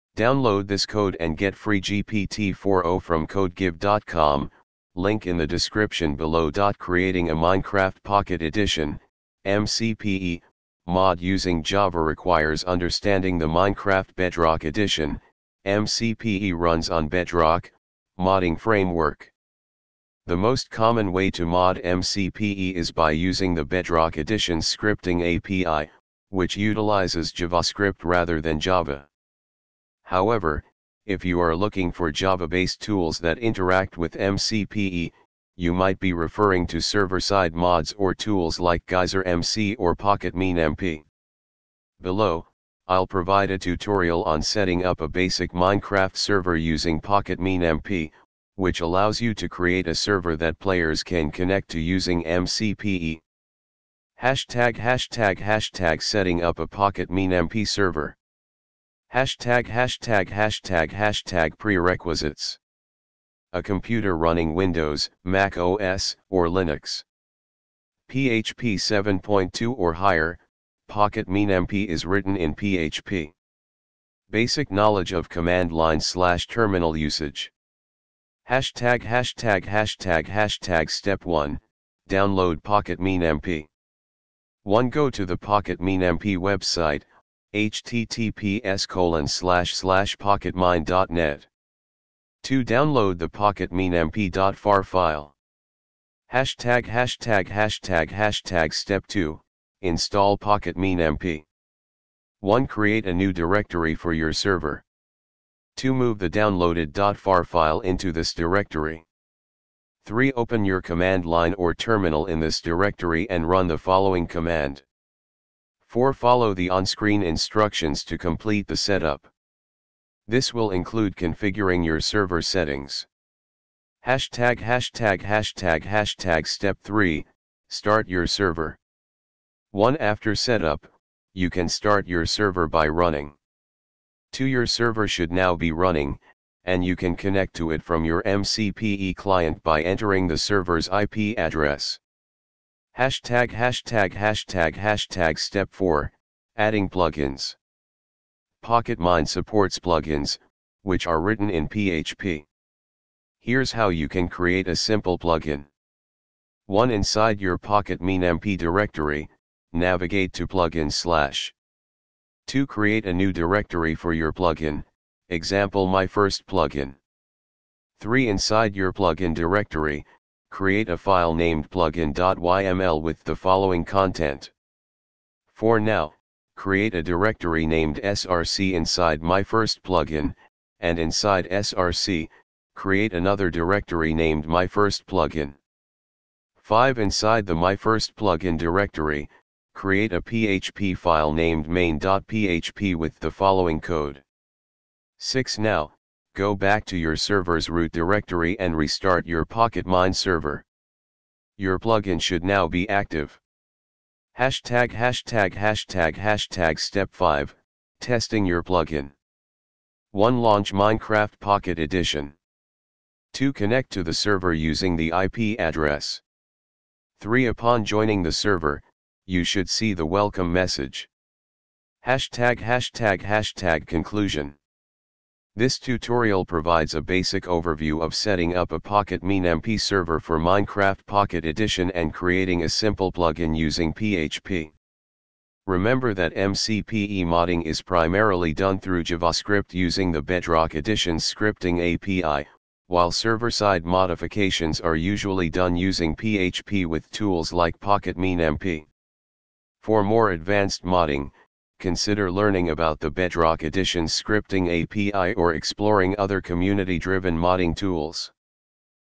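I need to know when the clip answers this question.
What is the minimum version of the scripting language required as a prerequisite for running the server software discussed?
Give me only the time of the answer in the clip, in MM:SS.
01:08.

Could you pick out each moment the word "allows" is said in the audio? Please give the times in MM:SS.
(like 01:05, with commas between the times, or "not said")
00:48.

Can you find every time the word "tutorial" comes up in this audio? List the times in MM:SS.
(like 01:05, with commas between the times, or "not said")
00:43, 03:45.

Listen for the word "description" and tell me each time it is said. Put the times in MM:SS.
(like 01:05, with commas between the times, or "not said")
00:05.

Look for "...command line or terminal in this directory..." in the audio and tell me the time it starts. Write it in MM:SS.
01:50.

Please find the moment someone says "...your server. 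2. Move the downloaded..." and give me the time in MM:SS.
01:44.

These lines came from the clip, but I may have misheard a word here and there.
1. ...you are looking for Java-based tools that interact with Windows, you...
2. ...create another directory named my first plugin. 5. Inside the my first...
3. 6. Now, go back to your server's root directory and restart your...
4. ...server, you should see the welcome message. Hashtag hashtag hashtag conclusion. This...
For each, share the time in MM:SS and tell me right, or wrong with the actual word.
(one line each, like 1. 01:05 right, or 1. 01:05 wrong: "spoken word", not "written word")
1. 00:31 wrong: "MCPE", not "Windows"
2. 03:02 right
3. 03:15 right
4. 03:38 right.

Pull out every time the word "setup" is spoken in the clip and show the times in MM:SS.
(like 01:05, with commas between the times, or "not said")
01:58, 02:10.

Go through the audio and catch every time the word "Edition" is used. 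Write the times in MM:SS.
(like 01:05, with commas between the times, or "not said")
00:08, 00:14, 00:24, 03:31, 03:51, 04:00, 04:13.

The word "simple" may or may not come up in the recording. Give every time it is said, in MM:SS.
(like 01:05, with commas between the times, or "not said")
02:34, 03:52.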